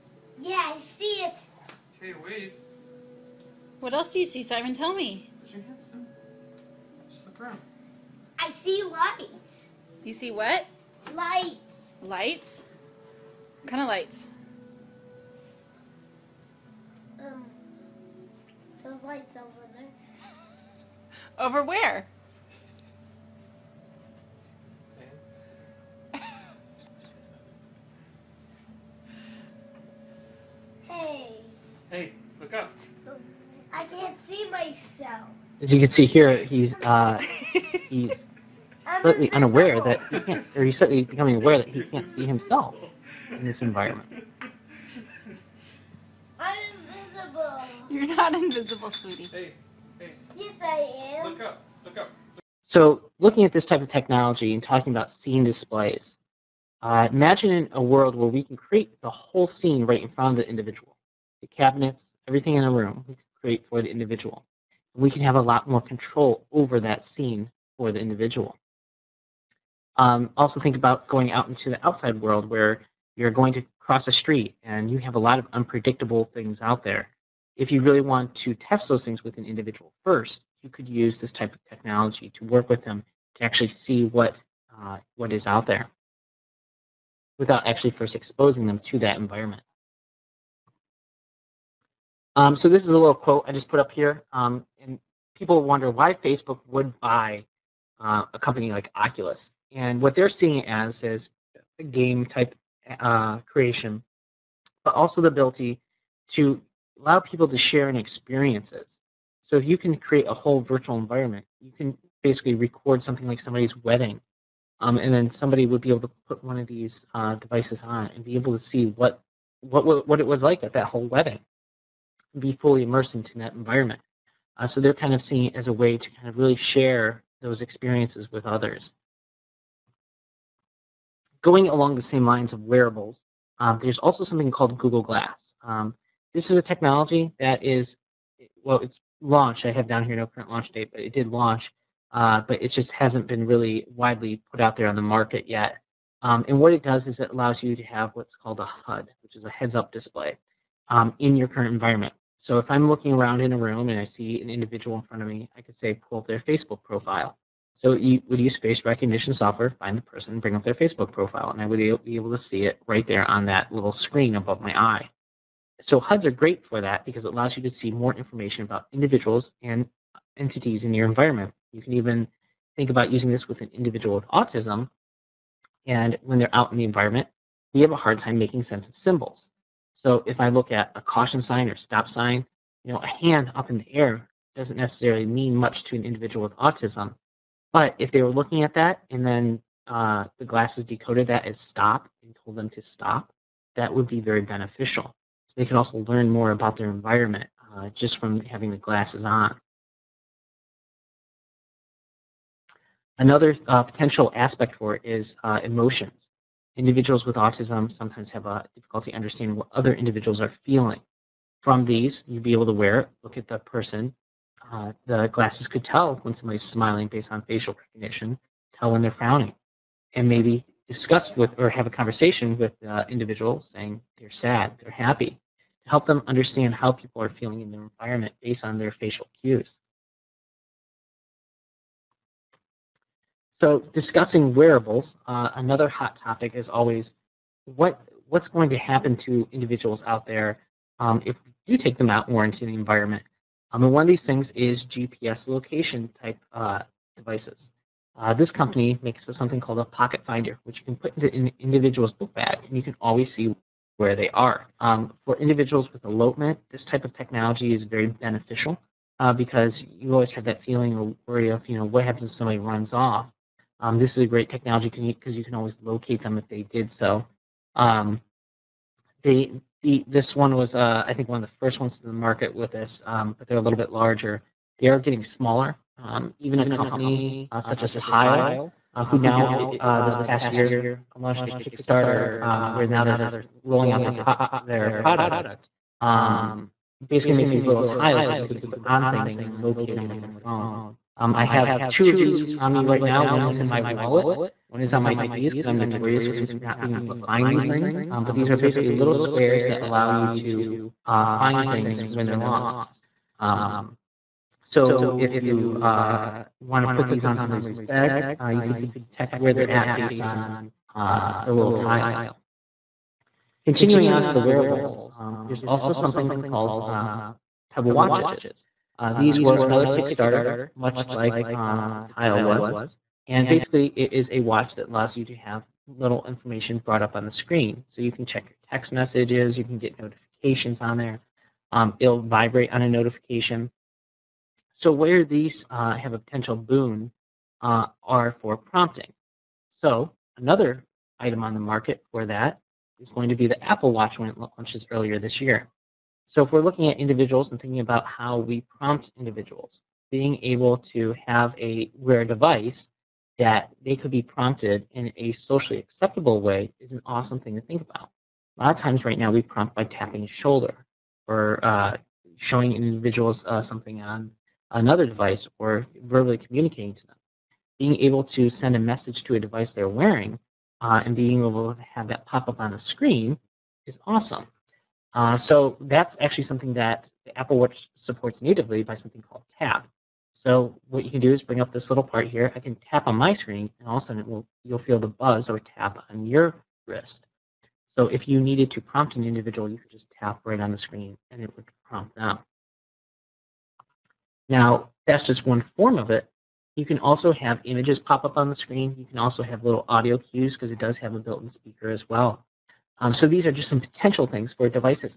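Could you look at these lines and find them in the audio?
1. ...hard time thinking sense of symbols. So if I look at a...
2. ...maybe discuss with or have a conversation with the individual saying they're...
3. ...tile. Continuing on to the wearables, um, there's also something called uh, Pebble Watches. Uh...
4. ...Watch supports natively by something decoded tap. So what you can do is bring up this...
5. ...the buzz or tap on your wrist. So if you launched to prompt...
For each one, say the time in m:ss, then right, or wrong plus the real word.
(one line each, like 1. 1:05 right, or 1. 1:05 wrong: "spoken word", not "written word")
1. 2:57 wrong: "making", not "thinking"
2. 3:40 right
3. 5:11 right
4. 6:17 wrong: "called", not "decoded"
5. 6:24 wrong: "needed", not "launched".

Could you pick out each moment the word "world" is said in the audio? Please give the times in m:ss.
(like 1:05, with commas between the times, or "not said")
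0:57, 1:12.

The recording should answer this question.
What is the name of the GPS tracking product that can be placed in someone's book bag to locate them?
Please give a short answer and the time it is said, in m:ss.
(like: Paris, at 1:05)
Pocket finder, at 4:09.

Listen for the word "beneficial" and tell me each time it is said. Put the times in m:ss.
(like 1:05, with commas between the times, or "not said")
3:14, 4:18.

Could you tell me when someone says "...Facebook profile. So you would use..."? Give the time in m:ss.
2:36.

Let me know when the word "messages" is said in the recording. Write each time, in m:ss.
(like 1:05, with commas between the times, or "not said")
5:28, 6:08.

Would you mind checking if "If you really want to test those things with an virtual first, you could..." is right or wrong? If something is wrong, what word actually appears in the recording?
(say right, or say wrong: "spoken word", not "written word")
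wrong: "individual", not "virtual".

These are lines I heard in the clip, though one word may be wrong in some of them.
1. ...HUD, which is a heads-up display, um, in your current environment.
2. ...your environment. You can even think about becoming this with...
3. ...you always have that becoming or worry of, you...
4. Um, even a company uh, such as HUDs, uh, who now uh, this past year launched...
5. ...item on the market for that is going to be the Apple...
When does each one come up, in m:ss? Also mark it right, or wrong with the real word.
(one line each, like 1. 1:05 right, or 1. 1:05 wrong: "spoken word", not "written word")
1. 2:28 right
2. 2:50 wrong: "using", not "becoming"
3. 4:19 wrong: "feeling", not "becoming"
4. 4:36 wrong: "Tile", not "HUDs"
5. 5:41 right.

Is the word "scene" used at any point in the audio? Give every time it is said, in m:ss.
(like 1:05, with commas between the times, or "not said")
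0:55, 0:59, 1:07.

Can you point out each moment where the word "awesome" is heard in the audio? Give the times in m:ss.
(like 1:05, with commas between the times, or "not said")
5:57, 6:14.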